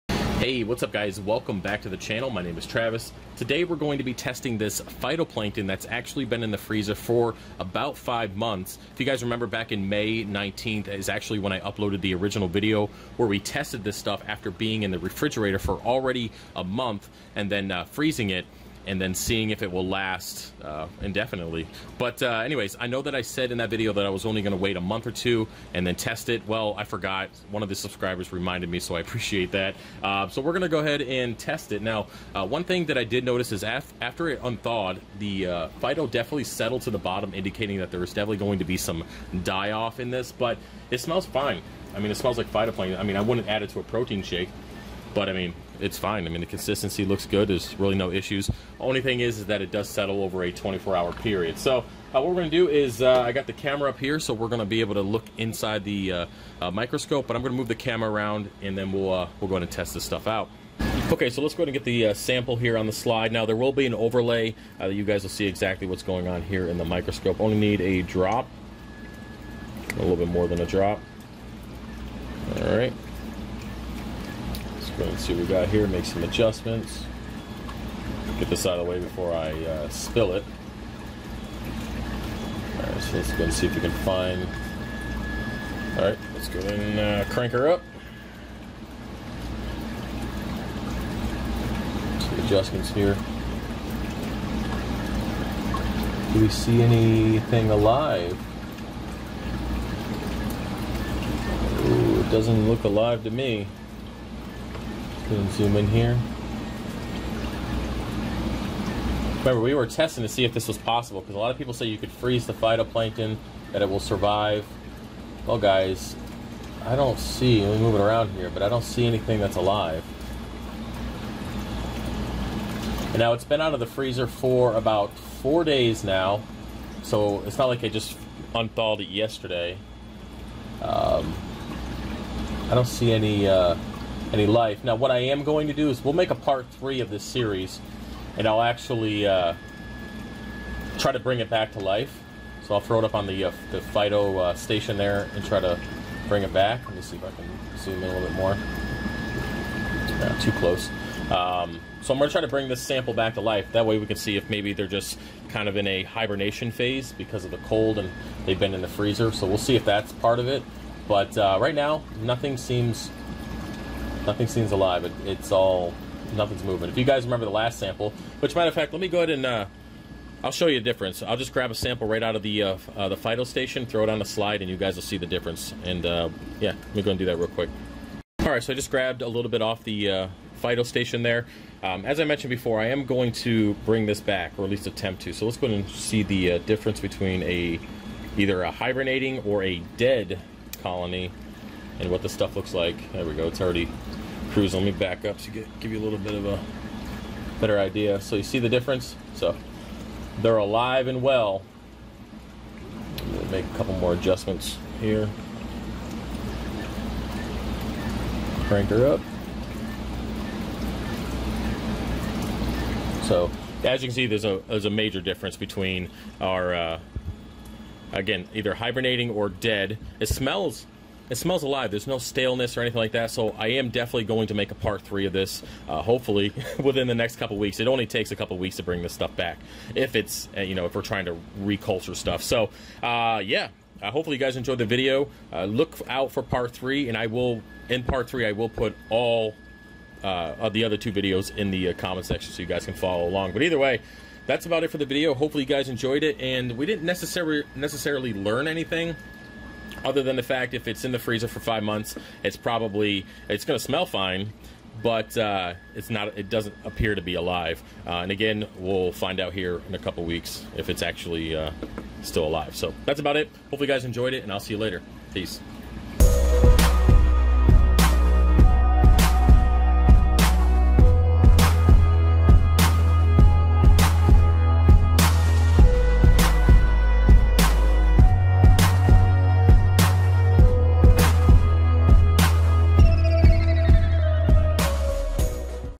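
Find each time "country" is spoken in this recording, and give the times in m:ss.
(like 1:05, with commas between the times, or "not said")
not said.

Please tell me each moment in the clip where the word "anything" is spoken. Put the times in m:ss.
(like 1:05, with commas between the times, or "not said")
1:36, 1:59, 3:42, 4:08.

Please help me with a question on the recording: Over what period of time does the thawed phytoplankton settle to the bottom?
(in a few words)
24 hours.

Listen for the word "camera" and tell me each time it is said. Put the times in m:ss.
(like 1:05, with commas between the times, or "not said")
0:53, 0:57.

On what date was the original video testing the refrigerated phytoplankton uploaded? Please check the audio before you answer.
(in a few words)
May 19th.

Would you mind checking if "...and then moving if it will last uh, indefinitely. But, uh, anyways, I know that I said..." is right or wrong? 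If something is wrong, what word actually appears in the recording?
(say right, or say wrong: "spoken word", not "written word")
wrong: "seeing", not "moving".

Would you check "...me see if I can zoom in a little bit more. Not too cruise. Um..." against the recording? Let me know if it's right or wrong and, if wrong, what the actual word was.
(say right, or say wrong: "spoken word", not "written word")
wrong: "close", not "cruise".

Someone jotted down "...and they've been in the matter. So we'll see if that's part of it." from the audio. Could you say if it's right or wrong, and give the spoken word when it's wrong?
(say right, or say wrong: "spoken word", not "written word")
wrong: "freezer", not "matter".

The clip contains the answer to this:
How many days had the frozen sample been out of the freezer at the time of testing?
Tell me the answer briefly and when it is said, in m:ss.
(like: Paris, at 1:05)
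4 days, at 2:05.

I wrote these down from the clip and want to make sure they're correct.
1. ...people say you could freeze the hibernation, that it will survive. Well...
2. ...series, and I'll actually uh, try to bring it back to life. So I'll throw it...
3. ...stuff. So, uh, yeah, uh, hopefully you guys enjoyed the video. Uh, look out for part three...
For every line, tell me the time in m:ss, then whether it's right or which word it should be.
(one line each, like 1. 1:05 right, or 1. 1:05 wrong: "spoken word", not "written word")
1. 1:51 wrong: "phytoplankton", not "hibernation"
2. 2:17 right
3. 3:52 right.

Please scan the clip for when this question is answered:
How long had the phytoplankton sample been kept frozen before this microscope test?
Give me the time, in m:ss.
0:07.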